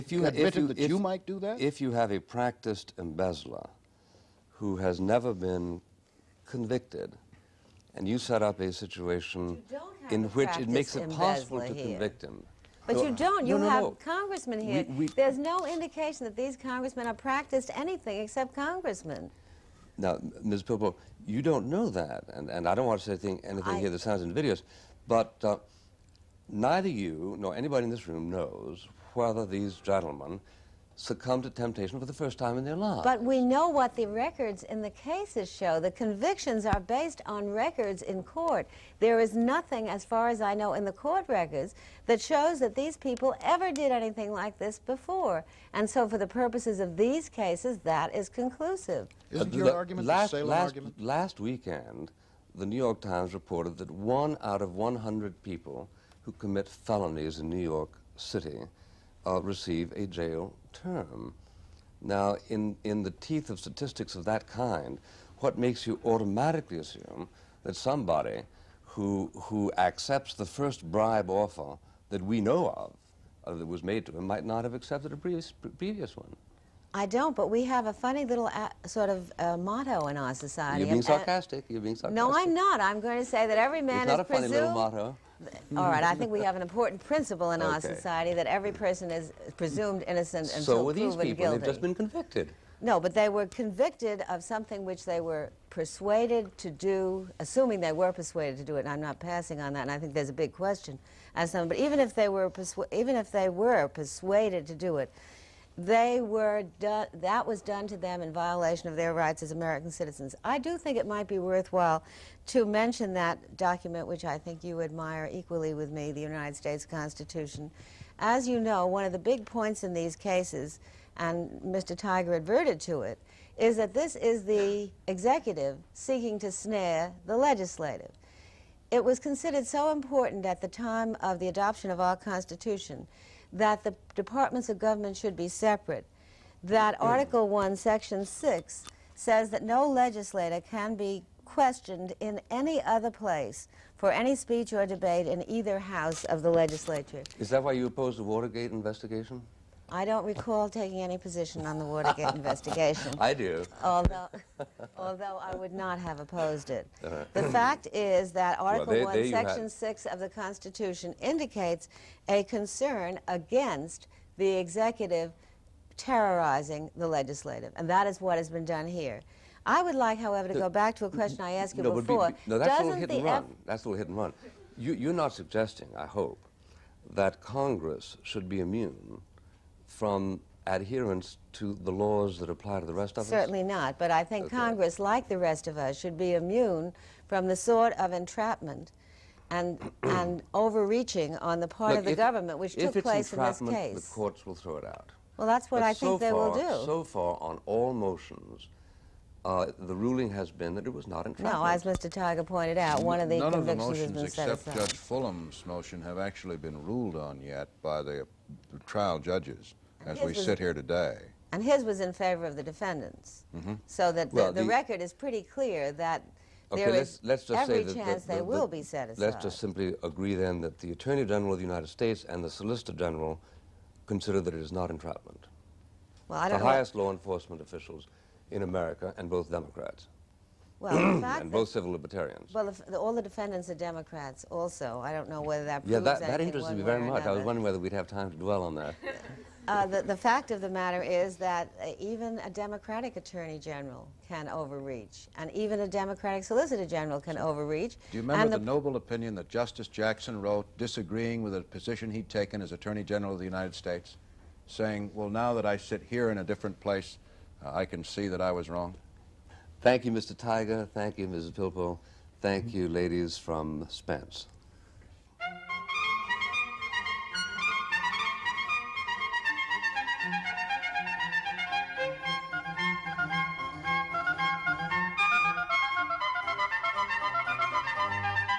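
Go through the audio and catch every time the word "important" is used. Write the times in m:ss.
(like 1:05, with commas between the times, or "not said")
1:26, 2:09.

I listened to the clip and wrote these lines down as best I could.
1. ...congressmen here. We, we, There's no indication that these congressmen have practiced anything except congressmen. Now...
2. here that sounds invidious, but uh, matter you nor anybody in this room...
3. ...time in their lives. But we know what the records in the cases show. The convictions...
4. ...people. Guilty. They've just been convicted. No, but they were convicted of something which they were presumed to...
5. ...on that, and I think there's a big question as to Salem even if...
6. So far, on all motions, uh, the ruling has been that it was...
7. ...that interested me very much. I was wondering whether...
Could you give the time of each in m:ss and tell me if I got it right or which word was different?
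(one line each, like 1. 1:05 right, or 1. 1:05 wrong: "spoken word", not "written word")
1. 0:13 right
2. 0:23 wrong: "neither", not "matter"
3. 0:32 right
4. 1:31 wrong: "persuaded", not "presumed"
5. 1:39 wrong: "But", not "Salem"
6. 3:16 right
7. 3:56 right.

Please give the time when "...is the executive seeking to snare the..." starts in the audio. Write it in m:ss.
2:04.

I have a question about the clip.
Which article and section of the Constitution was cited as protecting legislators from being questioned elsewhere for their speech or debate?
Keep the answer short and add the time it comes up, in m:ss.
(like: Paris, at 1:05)
Article 1, Section 6, at 2:17.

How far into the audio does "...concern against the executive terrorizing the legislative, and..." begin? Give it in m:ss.
2:42.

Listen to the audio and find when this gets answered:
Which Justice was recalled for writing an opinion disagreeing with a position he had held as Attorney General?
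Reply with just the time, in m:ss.
4:09.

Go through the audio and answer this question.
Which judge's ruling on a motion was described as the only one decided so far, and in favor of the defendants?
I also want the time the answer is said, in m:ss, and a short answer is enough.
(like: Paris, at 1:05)
Judge Fulham, at 3:24.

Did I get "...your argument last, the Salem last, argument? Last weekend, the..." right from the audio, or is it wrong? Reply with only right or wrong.
right.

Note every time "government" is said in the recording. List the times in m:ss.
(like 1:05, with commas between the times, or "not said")
2:14, 3:12.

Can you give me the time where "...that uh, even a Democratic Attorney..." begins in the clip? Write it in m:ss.
4:01.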